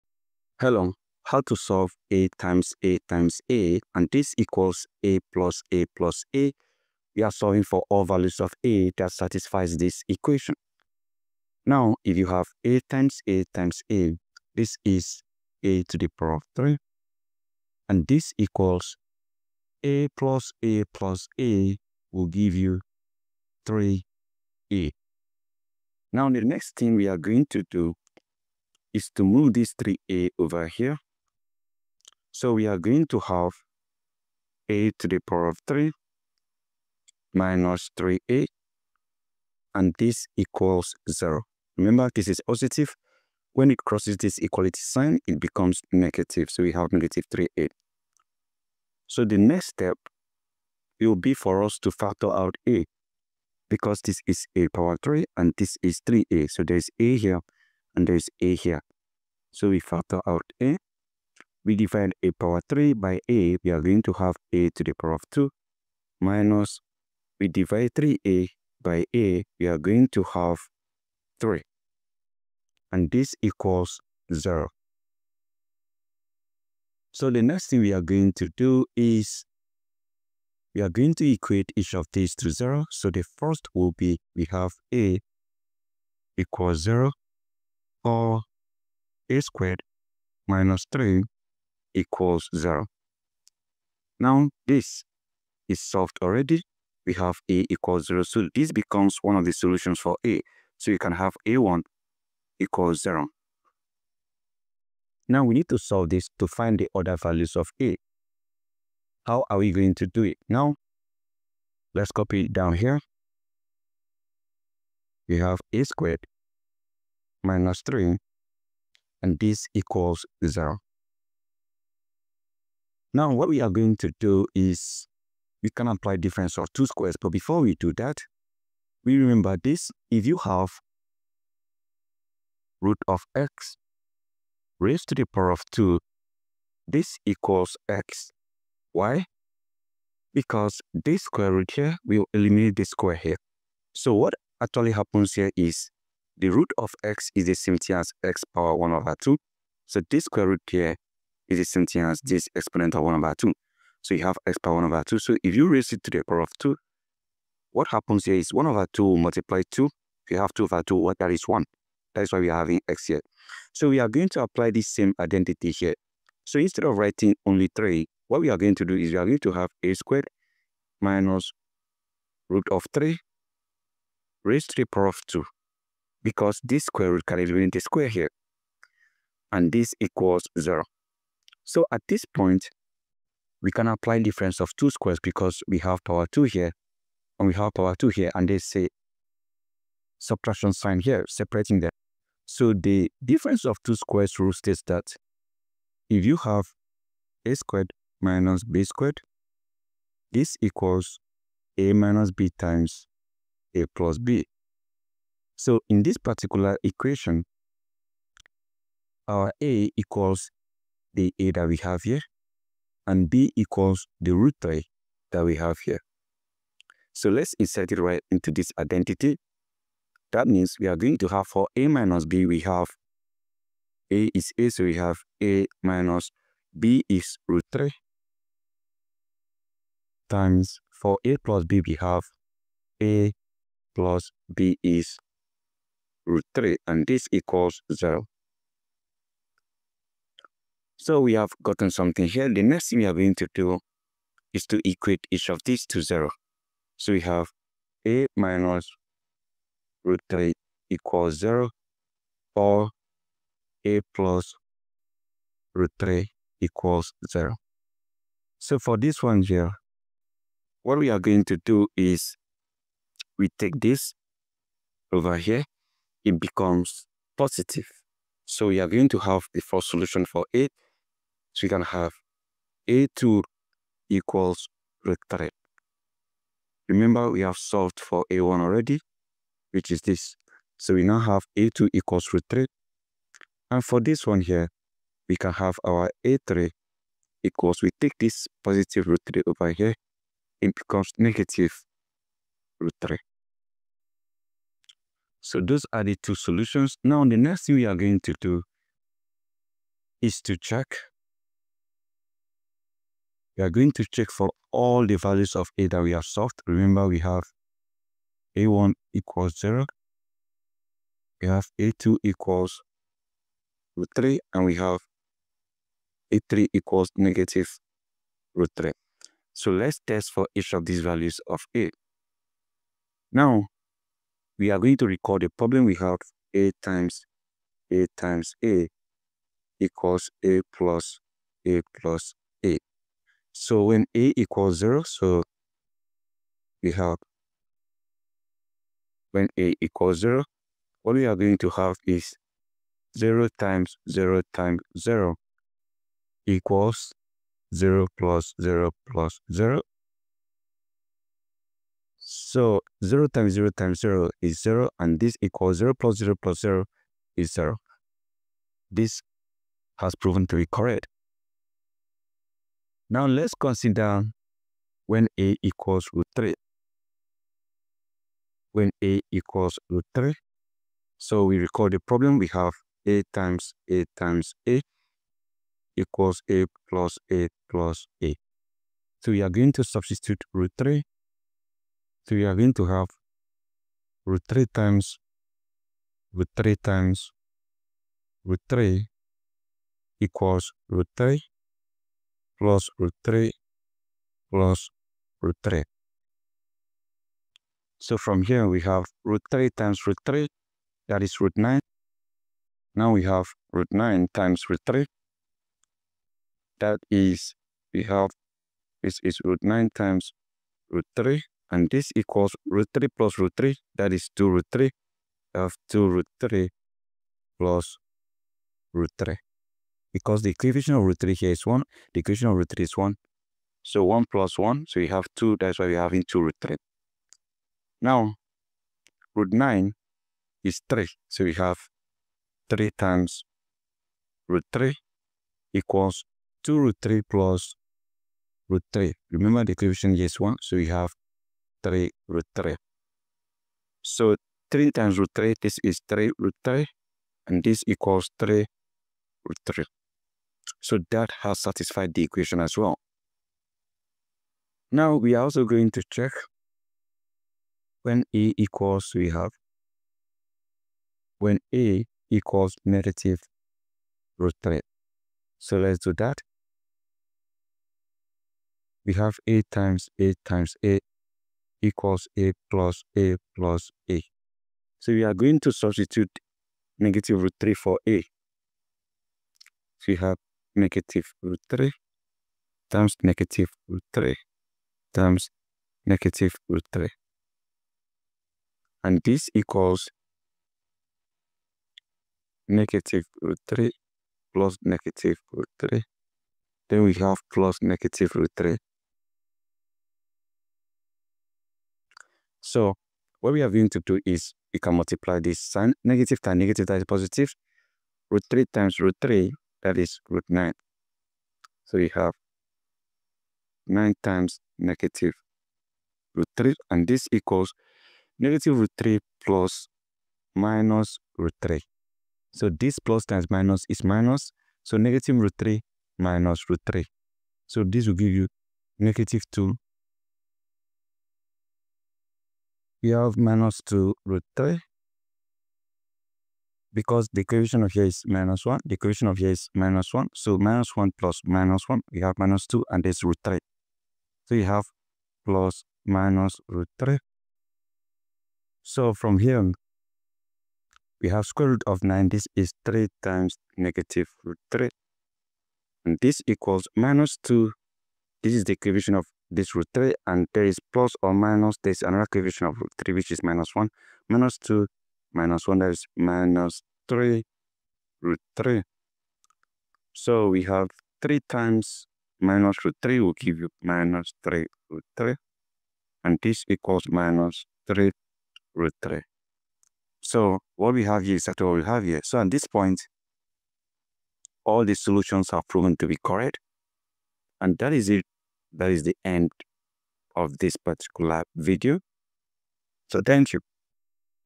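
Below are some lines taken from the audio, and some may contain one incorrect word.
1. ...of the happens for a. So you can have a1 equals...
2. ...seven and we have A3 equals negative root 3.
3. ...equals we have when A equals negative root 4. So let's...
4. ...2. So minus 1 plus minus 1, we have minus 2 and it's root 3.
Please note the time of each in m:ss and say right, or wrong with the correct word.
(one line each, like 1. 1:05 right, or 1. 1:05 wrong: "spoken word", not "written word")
1. 1:39 wrong: "solutions", not "happens"
2. 5:14 wrong: "three", not "seven"
3. 7:38 wrong: "3", not "4"
4. 9:00 wrong: "1", not "2".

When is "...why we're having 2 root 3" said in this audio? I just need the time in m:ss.
7:05.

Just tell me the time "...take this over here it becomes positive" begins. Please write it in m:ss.
4:23.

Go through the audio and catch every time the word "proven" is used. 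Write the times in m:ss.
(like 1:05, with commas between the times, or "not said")
6:00, 9:45.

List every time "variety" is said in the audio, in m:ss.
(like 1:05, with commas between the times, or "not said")
not said.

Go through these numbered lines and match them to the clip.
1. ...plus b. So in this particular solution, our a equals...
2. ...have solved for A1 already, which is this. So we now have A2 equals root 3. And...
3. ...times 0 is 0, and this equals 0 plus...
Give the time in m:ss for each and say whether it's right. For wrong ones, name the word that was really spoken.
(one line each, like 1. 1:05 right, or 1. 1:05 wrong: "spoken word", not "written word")
1. 3:23 wrong: "equation", not "solution"
2. 4:37 right
3. 5:53 right.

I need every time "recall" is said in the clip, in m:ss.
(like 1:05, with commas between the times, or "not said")
5:25, 6:11.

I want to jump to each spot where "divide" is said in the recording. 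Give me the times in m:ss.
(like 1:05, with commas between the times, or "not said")
1:07.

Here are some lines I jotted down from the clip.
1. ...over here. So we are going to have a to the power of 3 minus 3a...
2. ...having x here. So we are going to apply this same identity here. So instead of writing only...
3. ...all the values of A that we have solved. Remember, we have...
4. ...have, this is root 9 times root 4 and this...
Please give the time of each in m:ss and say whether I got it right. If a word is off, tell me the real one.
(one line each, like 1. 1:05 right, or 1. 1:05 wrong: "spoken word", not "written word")
1. 0:30 right
2. 2:42 right
3. 5:04 right
4. 6:48 wrong: "3", not "4".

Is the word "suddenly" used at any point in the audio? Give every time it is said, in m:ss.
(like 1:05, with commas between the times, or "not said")
not said.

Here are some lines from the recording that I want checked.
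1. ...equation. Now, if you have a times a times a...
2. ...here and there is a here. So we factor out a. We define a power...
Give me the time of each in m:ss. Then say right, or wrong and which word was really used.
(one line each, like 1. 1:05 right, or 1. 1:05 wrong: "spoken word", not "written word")
1. 0:10 right
2. 0:57 right.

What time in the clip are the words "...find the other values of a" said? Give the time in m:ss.
1:46.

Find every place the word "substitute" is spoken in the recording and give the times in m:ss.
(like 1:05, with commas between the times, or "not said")
6:19, 7:55.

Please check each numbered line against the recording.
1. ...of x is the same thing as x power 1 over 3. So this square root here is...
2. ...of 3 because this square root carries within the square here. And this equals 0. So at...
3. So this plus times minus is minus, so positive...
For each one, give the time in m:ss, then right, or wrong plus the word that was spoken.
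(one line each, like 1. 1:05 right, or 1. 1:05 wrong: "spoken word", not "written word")
1. 2:26 wrong: "2", not "3"
2. 2:55 wrong: "2", not "3"
3. 8:42 wrong: "negative", not "positive".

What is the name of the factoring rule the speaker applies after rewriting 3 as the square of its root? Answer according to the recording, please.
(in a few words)
difference of two squares.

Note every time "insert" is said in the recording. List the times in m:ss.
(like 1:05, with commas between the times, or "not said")
3:37.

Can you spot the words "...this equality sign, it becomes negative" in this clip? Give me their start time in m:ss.
0:44.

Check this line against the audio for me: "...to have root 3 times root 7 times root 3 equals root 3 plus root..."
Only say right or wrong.
wrong.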